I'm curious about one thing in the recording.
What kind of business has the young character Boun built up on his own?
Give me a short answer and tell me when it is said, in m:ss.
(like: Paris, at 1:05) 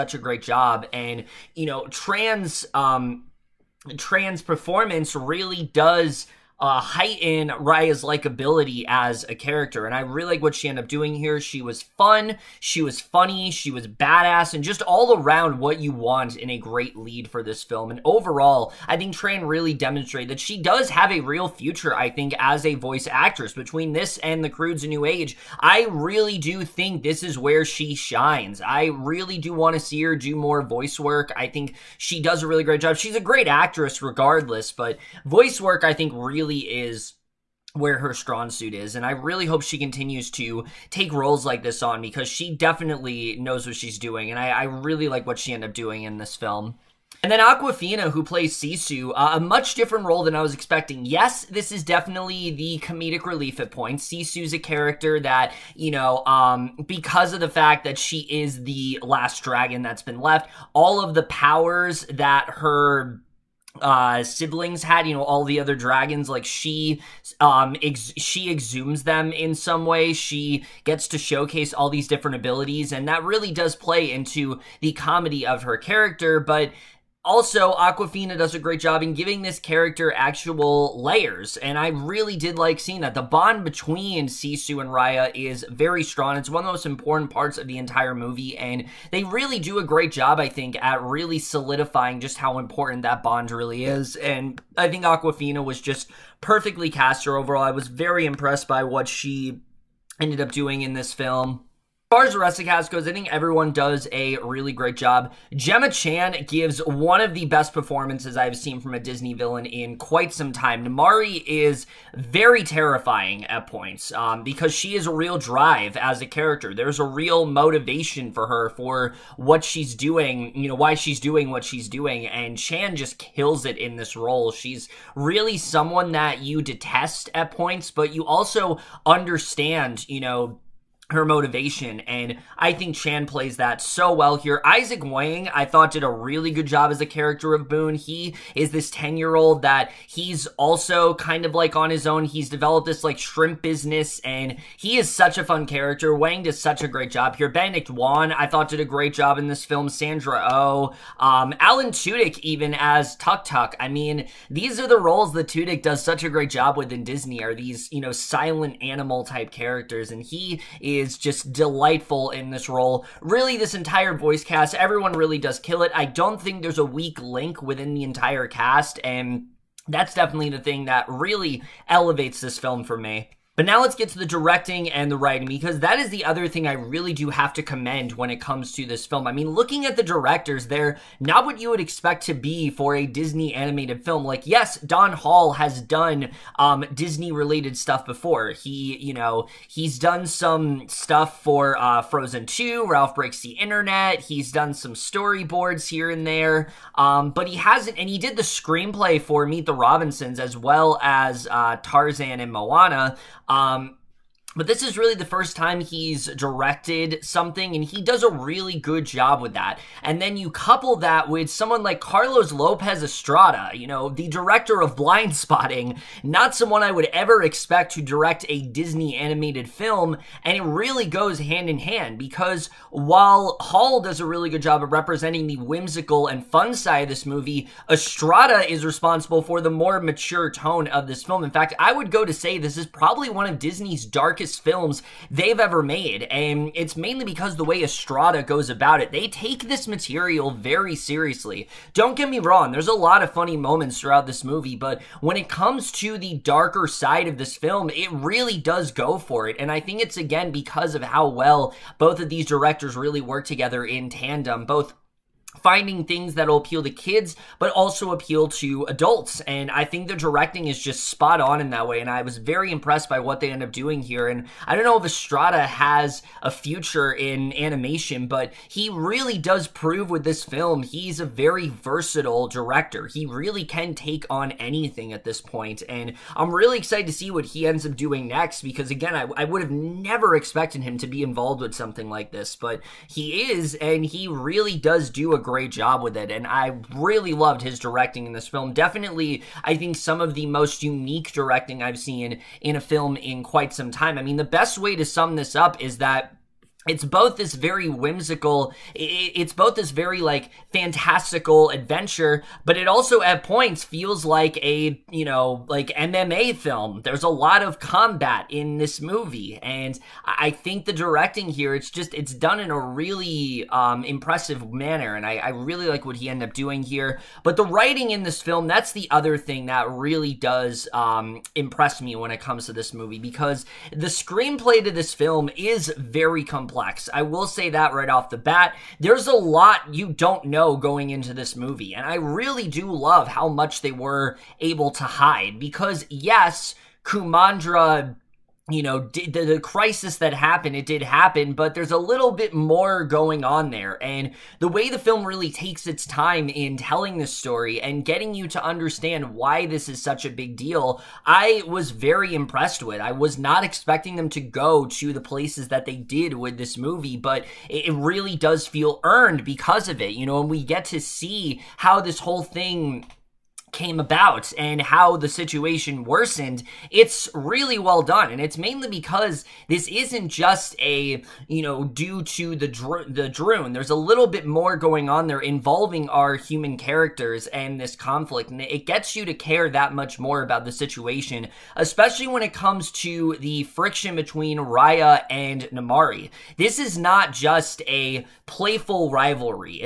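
Shrimp business, at 2:23.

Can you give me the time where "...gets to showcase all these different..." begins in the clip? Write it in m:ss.
1:10.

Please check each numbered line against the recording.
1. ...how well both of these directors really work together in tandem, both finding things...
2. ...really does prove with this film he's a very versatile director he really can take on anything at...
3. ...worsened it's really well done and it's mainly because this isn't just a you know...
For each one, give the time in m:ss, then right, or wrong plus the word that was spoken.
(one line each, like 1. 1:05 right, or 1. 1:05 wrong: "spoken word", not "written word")
1. 4:11 right
2. 4:28 right
3. 6:06 right.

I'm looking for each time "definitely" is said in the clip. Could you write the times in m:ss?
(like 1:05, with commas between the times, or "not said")
0:42, 0:51, 2:50, 4:48.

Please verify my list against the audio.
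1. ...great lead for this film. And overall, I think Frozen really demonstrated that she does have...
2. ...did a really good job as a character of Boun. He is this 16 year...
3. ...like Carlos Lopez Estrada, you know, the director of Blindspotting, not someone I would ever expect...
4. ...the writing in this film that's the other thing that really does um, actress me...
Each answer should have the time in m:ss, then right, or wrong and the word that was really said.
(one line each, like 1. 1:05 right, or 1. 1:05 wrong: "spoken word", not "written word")
1. 0:16 wrong: "Tran", not "Frozen"
2. 2:15 wrong: "10", not "16"
3. 3:31 right
4. 5:17 wrong: "impress", not "actress".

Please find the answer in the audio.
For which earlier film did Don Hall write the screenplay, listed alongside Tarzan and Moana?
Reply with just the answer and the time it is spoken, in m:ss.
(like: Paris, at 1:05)
Meet the Robinsons, at 3:19.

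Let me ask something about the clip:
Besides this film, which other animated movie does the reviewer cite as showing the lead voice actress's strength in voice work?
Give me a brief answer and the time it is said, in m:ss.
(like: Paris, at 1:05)
The Croods New Age, at 0:24.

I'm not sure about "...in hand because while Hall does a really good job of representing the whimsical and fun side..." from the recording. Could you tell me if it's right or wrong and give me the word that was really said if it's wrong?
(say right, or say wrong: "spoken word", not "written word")
right.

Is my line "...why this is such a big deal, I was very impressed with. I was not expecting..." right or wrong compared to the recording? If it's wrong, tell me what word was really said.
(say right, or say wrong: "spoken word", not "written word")
right.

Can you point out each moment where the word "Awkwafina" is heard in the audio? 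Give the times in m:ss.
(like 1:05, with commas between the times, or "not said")
0:47, 1:17, 1:35.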